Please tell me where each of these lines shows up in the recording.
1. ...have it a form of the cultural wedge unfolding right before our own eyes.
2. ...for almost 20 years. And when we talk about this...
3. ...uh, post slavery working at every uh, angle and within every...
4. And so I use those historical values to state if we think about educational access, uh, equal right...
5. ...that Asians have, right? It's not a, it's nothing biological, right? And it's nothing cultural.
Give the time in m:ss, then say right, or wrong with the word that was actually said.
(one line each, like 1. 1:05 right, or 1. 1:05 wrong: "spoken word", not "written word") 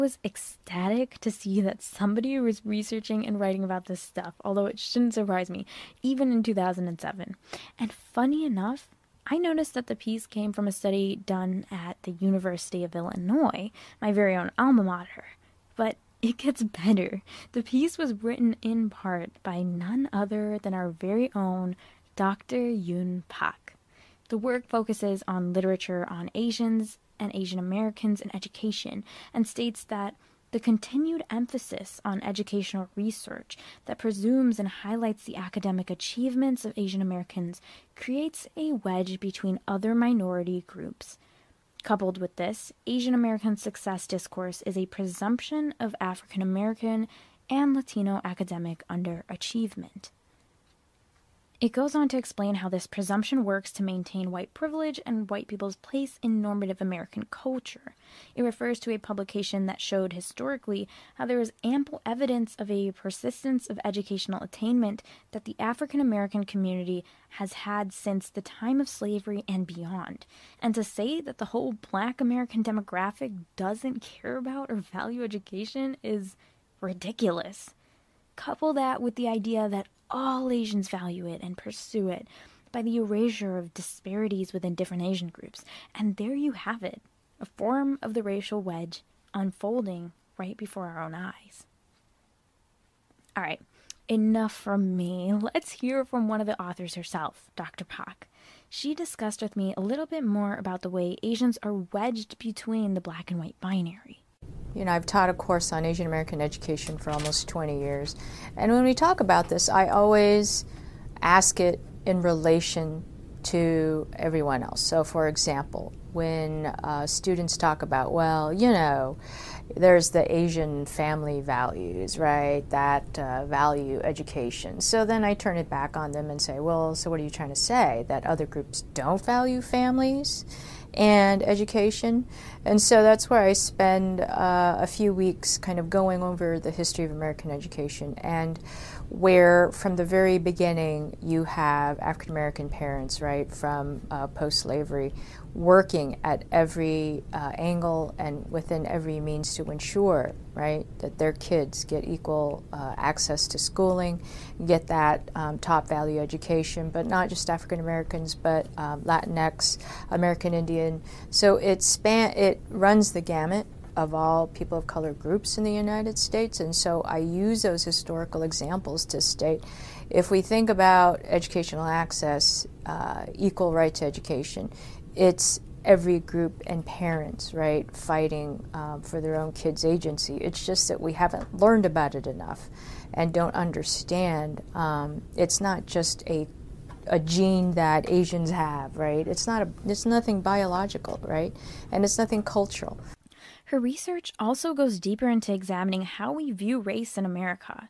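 1. 1:26 wrong: "racial", not "cultural"
2. 1:46 right
3. 2:24 right
4. 2:46 wrong: "examples", not "values"
5. 3:07 right.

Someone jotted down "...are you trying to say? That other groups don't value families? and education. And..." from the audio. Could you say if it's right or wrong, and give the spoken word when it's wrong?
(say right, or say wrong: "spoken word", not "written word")
right.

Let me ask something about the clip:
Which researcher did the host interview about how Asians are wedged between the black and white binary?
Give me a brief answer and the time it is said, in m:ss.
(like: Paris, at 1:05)
Dr. Pak, at 1:37.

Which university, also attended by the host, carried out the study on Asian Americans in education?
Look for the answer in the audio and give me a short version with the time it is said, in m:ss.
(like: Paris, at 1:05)
University of Illinois, at 0:12.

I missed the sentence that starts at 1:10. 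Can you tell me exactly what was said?
And to say that the whole black American demographic doesn't care about or value education is ridiculous.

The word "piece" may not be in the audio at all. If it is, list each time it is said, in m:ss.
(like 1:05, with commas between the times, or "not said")
0:09, 0:17.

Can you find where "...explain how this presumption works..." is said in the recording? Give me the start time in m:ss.
0:52.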